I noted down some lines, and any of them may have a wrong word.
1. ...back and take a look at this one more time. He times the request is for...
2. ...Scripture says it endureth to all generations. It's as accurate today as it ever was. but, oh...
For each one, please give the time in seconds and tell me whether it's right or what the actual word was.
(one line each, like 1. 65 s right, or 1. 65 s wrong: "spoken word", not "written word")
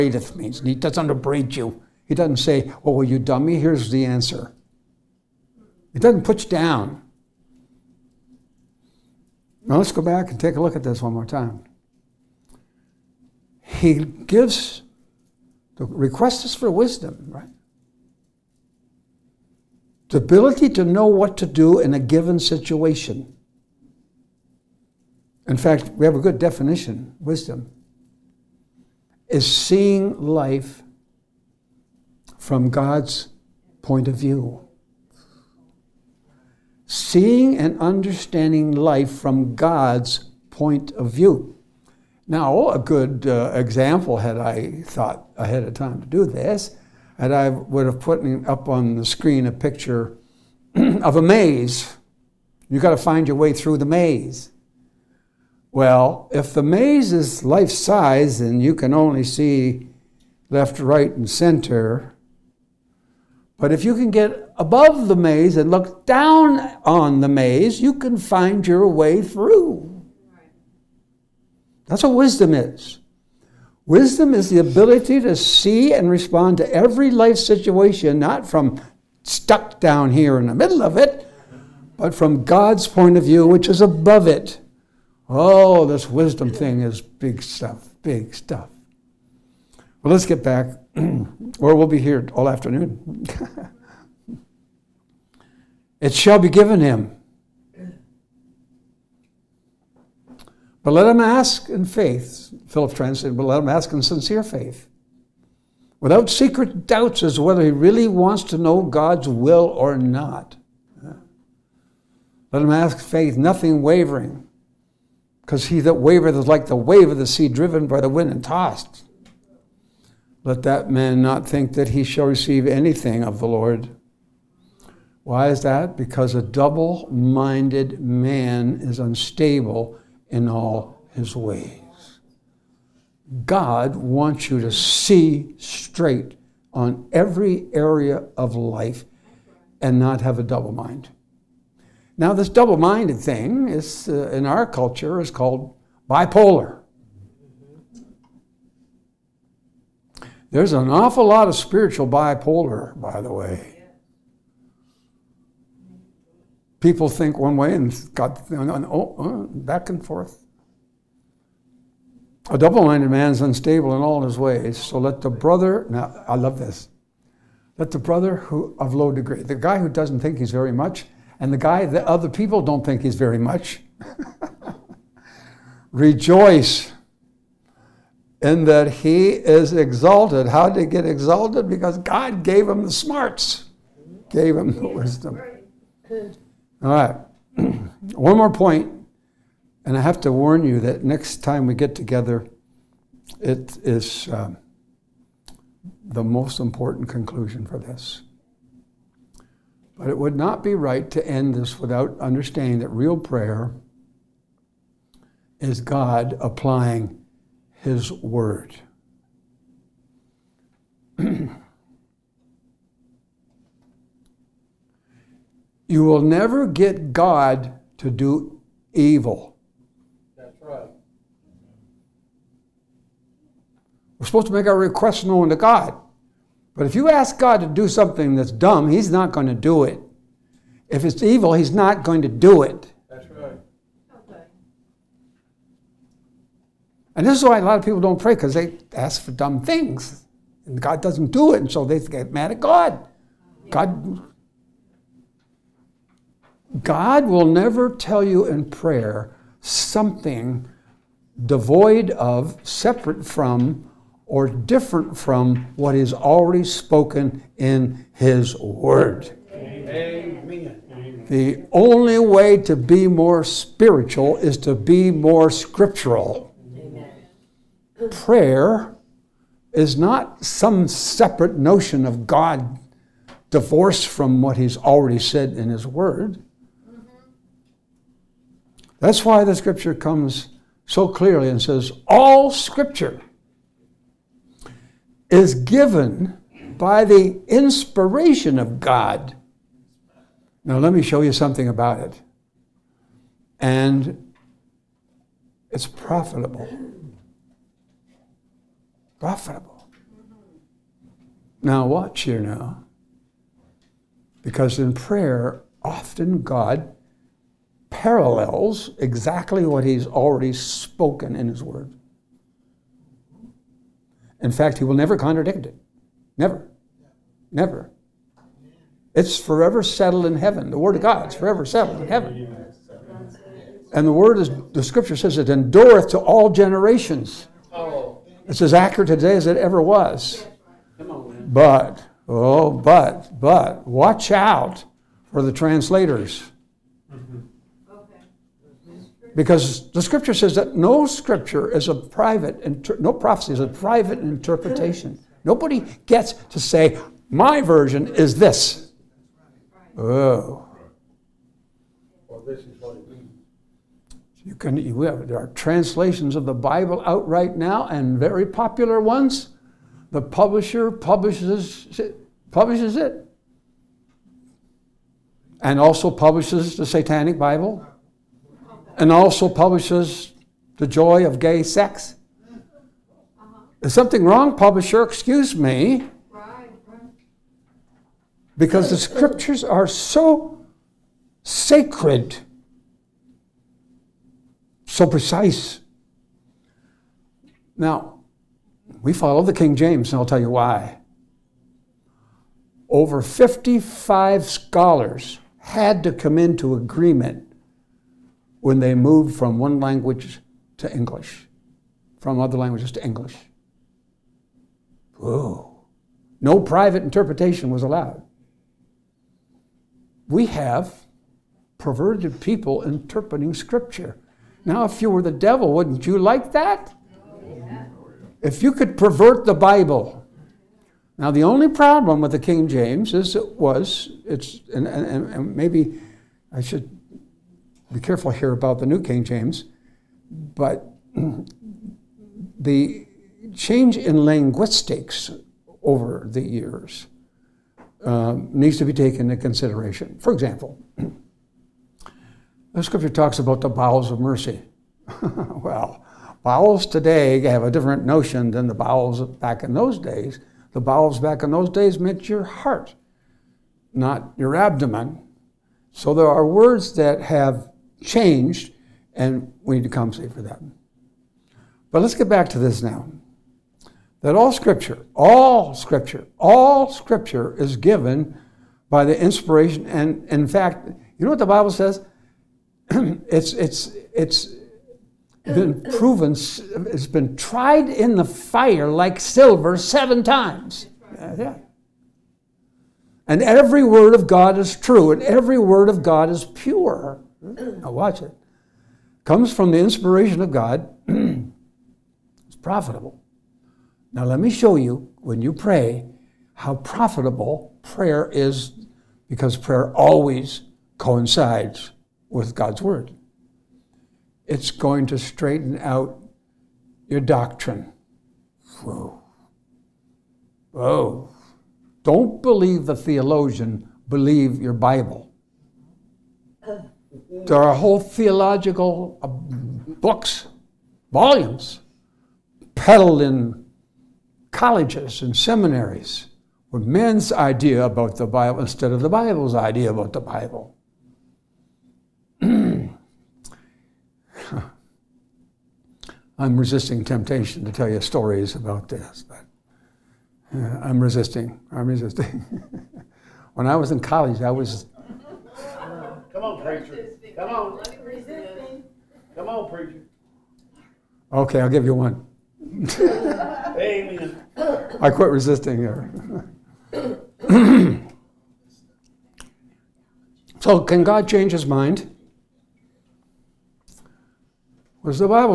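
1. 10 s wrong: "gives", not "times"
2. 324 s right.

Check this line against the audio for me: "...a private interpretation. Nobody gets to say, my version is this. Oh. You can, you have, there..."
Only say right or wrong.
right.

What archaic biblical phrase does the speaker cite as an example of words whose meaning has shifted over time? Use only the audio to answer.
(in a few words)
Bowels of mercy.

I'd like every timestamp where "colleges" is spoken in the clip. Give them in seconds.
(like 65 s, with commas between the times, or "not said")
524 s, 543 s.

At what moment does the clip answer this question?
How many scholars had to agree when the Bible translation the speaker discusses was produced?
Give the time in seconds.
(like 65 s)
392 s.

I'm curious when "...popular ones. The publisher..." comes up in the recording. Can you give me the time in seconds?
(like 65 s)
358 s.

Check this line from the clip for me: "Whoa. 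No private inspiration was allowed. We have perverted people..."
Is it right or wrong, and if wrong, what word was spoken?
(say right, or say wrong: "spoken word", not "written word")
wrong: "interpretation", not "inspiration".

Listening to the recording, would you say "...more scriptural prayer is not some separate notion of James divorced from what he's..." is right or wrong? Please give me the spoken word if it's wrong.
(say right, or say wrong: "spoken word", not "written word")
wrong: "God", not "James".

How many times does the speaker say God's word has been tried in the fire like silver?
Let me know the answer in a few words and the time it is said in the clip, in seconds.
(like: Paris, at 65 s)
7, at 479 s.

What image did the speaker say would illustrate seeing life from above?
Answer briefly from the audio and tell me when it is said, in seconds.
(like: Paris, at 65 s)
A maze, at 51 s.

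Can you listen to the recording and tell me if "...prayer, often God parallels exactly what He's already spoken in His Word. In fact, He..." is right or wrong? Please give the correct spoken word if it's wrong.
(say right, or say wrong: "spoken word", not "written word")
right.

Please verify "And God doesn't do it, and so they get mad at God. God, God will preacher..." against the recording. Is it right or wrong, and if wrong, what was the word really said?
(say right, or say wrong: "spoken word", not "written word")
wrong: "never", not "preacher".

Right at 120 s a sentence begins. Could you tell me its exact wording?
Let that man not think that he shall receive anything of the Lord.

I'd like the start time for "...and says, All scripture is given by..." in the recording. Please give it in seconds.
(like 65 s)
281 s.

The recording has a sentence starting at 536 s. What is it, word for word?
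I'm resisting temptation to tell you stories about this, but uh, I'm resisting.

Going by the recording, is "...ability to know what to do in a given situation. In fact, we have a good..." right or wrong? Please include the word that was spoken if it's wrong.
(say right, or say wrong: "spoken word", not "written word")
right.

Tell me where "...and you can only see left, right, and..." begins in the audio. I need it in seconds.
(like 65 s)
58 s.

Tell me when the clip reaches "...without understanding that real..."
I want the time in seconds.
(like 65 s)
201 s.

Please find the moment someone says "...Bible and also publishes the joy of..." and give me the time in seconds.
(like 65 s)
367 s.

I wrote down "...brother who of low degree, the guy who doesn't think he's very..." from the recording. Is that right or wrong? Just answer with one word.
right.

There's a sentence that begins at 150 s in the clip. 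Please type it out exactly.
There's an awful lot of spiritual bipolar, by the way.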